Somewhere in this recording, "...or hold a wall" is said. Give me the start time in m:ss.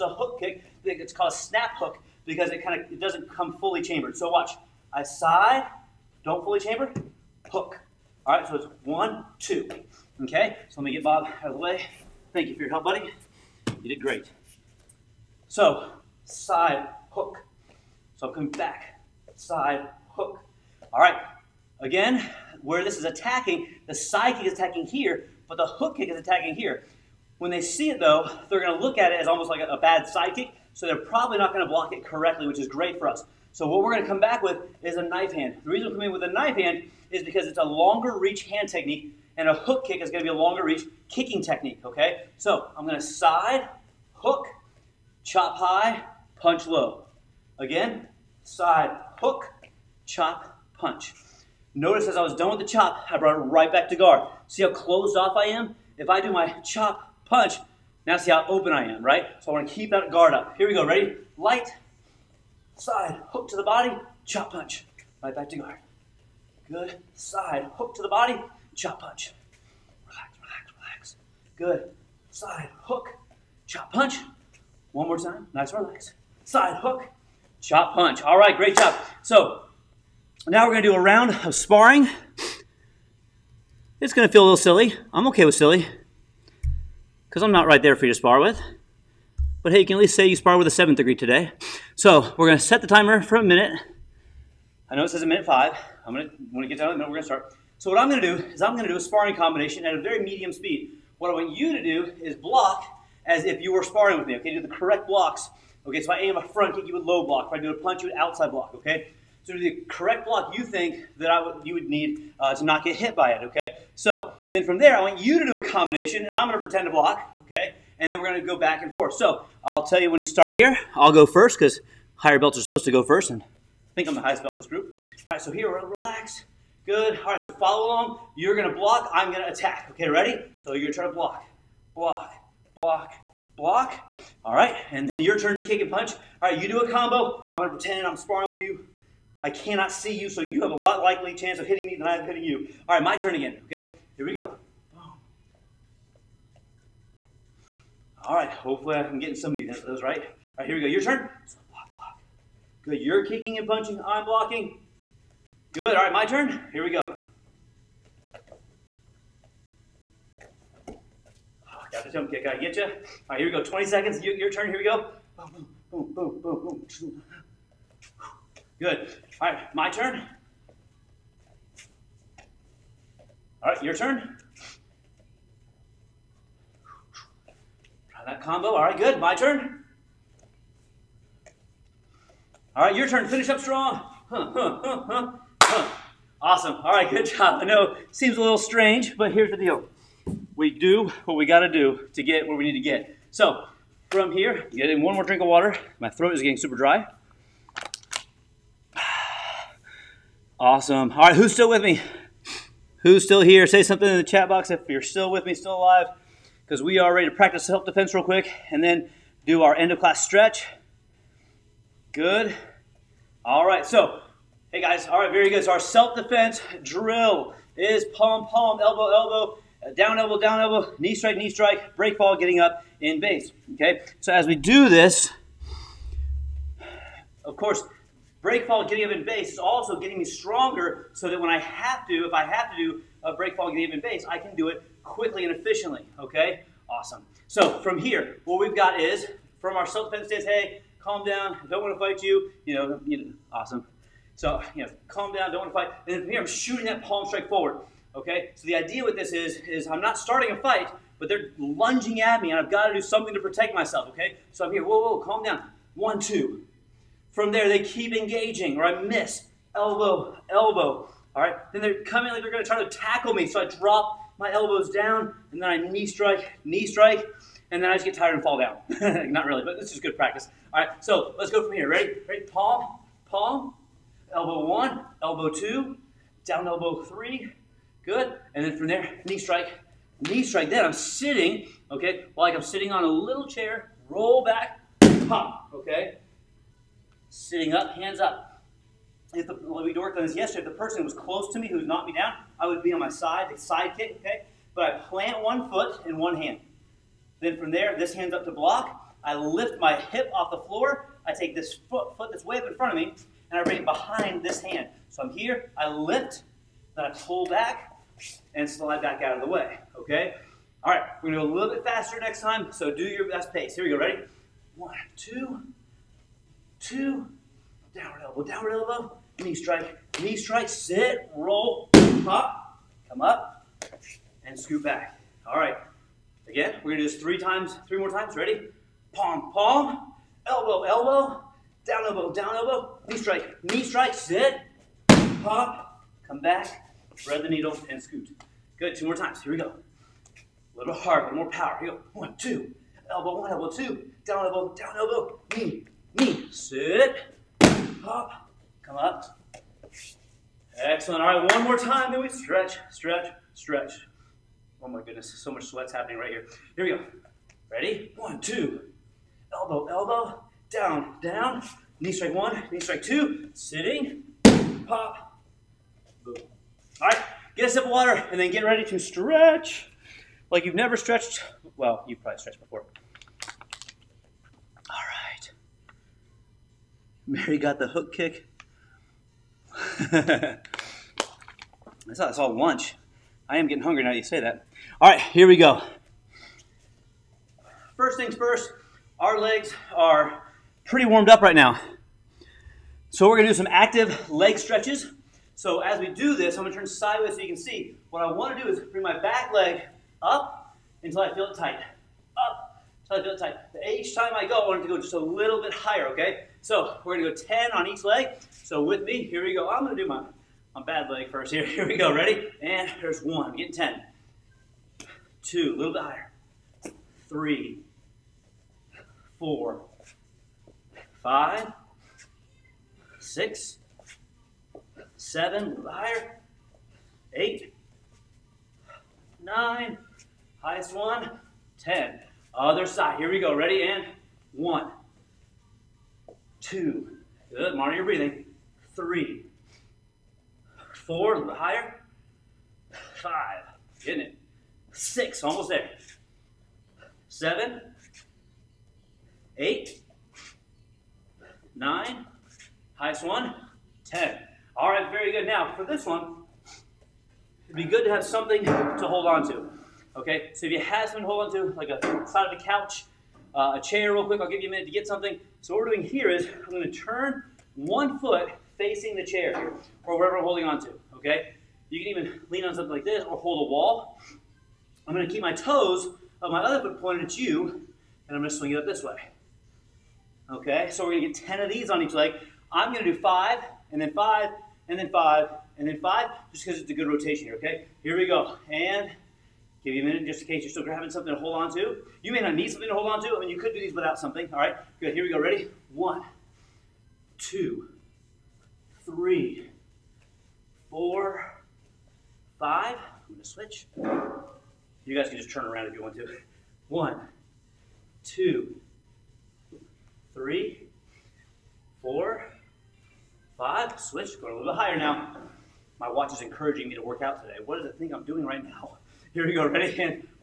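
7:53.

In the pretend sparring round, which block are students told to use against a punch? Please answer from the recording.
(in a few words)
Outside block.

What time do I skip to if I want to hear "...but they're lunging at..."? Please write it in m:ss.
4:11.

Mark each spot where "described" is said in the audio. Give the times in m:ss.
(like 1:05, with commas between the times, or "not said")
not said.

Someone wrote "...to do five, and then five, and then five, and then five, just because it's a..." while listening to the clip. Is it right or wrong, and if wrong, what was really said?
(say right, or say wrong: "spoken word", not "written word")
right.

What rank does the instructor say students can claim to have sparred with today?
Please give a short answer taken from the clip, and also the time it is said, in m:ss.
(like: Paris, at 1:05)
Seventh degree, at 1:30.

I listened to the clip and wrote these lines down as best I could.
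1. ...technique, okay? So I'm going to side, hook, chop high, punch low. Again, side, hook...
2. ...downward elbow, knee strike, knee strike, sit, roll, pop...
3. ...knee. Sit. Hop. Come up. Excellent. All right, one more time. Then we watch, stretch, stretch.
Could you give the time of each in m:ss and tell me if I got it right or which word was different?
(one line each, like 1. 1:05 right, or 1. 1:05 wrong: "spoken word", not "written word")
1. 0:41 right
2. 5:18 right
3. 5:46 wrong: "stretch", not "watch".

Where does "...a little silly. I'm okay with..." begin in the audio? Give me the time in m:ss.
1:24.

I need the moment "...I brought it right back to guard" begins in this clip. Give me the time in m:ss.
0:53.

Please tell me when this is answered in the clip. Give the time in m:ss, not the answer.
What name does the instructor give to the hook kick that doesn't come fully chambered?
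0:01.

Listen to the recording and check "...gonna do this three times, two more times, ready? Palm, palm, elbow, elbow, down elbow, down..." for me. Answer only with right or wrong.
wrong.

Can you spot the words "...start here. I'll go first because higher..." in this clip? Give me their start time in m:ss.
2:00.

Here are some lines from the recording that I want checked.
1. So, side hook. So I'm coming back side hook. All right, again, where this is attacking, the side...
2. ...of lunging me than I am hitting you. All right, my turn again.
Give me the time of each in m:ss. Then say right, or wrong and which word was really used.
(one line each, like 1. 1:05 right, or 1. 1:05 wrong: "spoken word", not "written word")
1. 0:15 right
2. 2:21 wrong: "hitting", not "lunging".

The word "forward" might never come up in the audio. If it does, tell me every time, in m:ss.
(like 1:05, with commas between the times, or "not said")
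4:07.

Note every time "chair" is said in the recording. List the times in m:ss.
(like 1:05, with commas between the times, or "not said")
4:43, 7:43, 7:49.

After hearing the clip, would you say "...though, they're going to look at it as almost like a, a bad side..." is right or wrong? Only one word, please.
right.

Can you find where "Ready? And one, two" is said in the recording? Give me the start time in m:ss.
7:13.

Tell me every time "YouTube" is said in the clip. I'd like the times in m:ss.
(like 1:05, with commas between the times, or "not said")
not said.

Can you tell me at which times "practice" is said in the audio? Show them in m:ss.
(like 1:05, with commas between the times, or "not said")
3:27, 4:30.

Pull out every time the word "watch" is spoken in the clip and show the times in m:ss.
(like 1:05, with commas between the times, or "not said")
0:04, 8:36.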